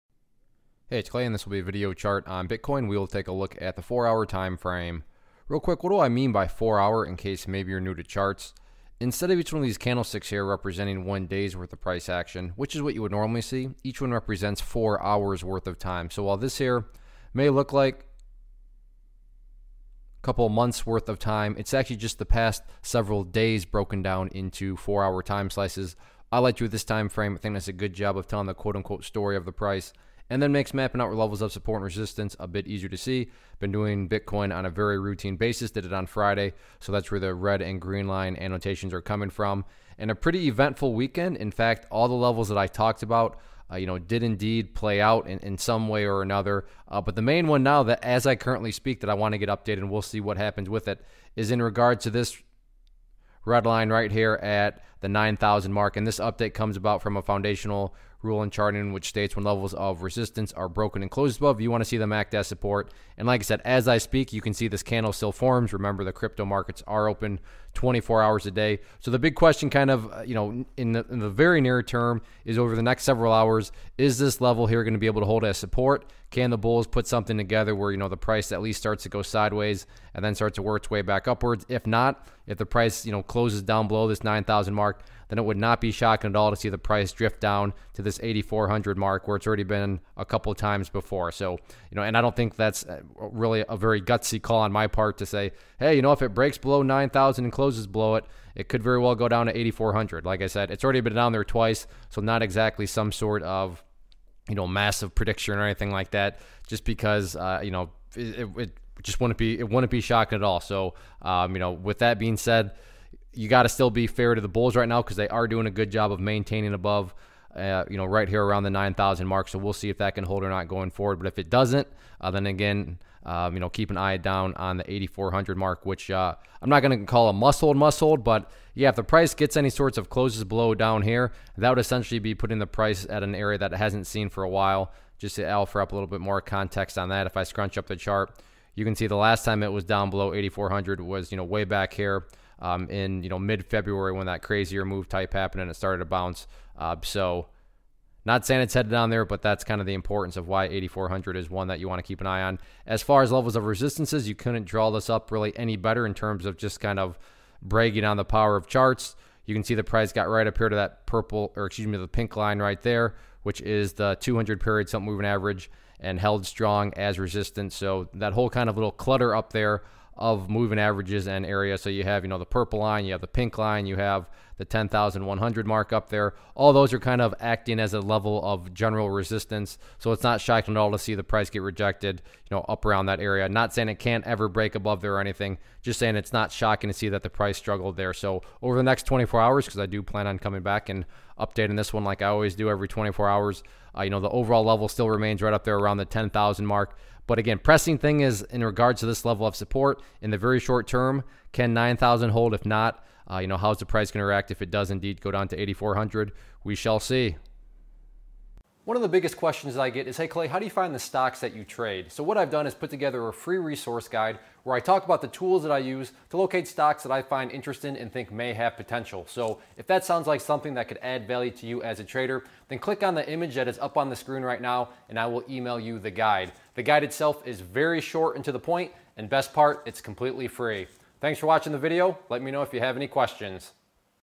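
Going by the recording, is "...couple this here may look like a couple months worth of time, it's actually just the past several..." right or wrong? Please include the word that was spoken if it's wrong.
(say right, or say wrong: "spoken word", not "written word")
wrong: "while", not "couple".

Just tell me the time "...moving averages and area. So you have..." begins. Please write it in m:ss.
2:50.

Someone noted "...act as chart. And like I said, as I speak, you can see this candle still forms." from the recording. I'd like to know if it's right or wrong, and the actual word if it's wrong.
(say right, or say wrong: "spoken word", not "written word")
wrong: "support", not "chart".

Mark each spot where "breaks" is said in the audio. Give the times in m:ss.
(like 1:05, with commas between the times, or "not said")
1:36, 3:04.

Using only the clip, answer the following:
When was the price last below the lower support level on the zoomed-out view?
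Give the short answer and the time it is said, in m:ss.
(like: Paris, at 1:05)
mid February, at 2:23.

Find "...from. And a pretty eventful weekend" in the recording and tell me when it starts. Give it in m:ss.
0:39.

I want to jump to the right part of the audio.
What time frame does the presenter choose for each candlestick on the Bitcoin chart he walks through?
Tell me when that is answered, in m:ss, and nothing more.
0:03.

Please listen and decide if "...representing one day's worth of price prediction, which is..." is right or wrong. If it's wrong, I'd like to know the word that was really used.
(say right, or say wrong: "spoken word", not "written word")
wrong: "action", not "prediction".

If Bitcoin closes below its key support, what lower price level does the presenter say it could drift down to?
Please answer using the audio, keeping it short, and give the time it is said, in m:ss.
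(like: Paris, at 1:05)
8400, at 1:28.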